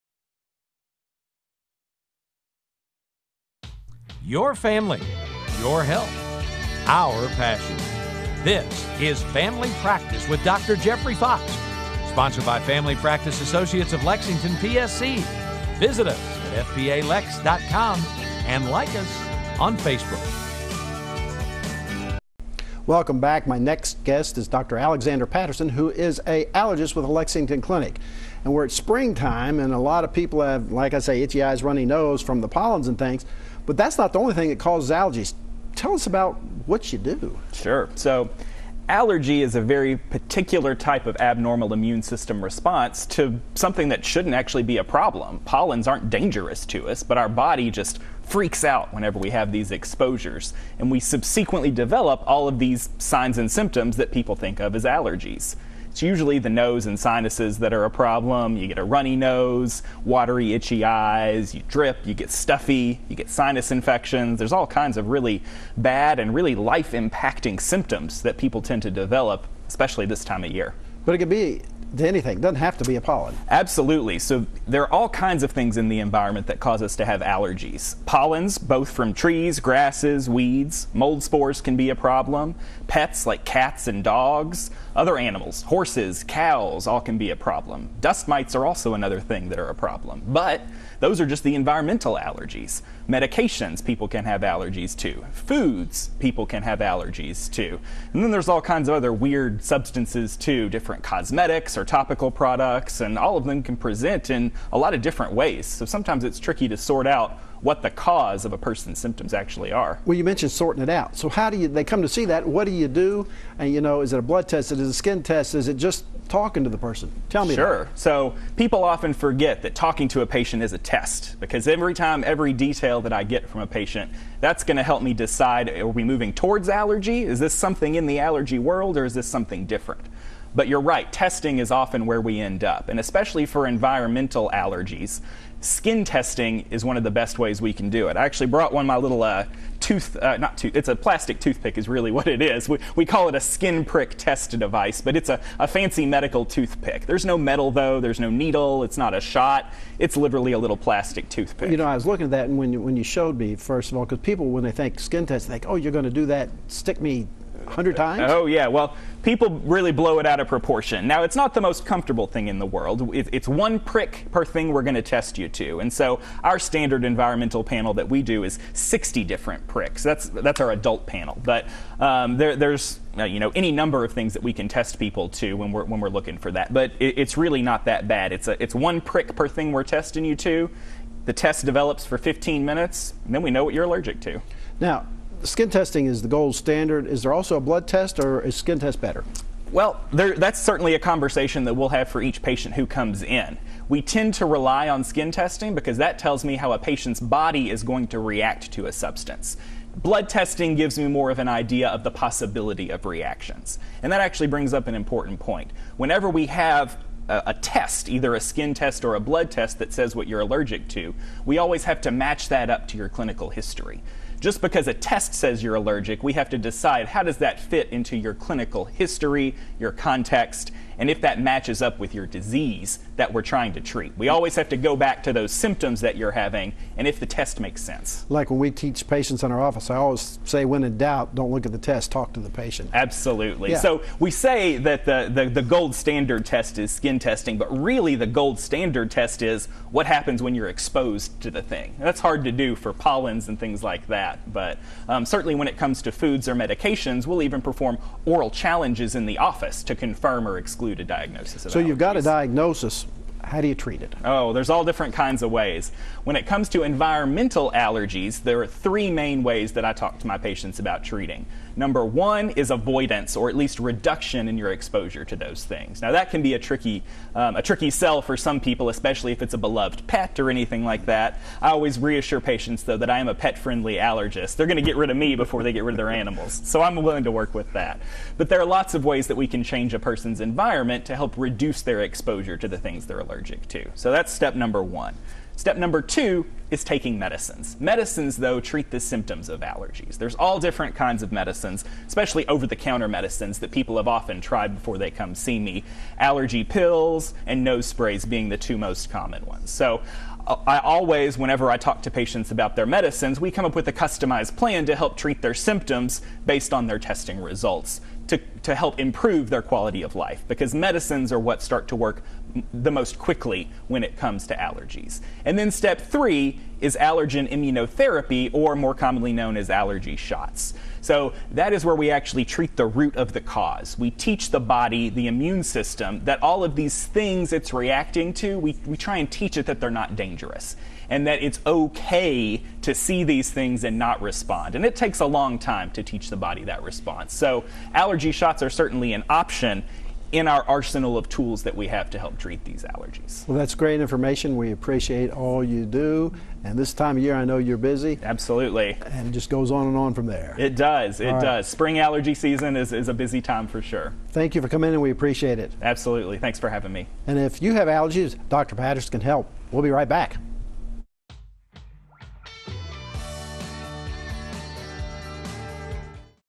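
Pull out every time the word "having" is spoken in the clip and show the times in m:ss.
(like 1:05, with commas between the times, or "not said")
3:46, 5:56.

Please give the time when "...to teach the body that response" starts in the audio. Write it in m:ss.
5:35.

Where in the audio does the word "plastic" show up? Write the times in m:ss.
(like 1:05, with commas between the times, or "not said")
2:20, 2:30.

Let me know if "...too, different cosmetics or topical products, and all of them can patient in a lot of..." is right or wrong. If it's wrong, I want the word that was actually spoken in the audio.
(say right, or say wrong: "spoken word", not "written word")
wrong: "present", not "patient".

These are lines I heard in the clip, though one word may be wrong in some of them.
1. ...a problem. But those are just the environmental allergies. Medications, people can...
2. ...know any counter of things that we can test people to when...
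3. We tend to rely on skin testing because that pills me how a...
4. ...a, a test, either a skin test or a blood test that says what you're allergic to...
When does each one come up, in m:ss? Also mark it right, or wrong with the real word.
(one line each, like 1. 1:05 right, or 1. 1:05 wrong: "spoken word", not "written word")
1. 1:29 right
2. 2:53 wrong: "number", not "counter"
3. 3:13 wrong: "tells", not "pills"
4. 3:27 right.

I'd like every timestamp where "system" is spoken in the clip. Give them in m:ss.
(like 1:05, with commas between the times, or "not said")
0:42, 5:25.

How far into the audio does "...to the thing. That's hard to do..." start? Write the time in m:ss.
4:01.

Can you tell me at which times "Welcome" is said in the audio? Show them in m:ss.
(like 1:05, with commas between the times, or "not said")
0:22.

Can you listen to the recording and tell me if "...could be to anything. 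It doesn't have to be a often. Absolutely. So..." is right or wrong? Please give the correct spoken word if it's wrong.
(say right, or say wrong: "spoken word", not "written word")
wrong: "pollen", not "often".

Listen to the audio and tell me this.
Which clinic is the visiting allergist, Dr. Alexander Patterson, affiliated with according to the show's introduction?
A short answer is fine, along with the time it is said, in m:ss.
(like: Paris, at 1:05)
Lexington Clinic, at 0:27.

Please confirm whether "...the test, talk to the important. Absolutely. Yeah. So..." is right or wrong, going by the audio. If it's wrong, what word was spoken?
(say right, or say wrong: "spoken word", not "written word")
wrong: "patient", not "important".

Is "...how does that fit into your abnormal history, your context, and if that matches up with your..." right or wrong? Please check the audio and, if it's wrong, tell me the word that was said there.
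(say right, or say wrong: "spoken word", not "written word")
wrong: "clinical", not "abnormal".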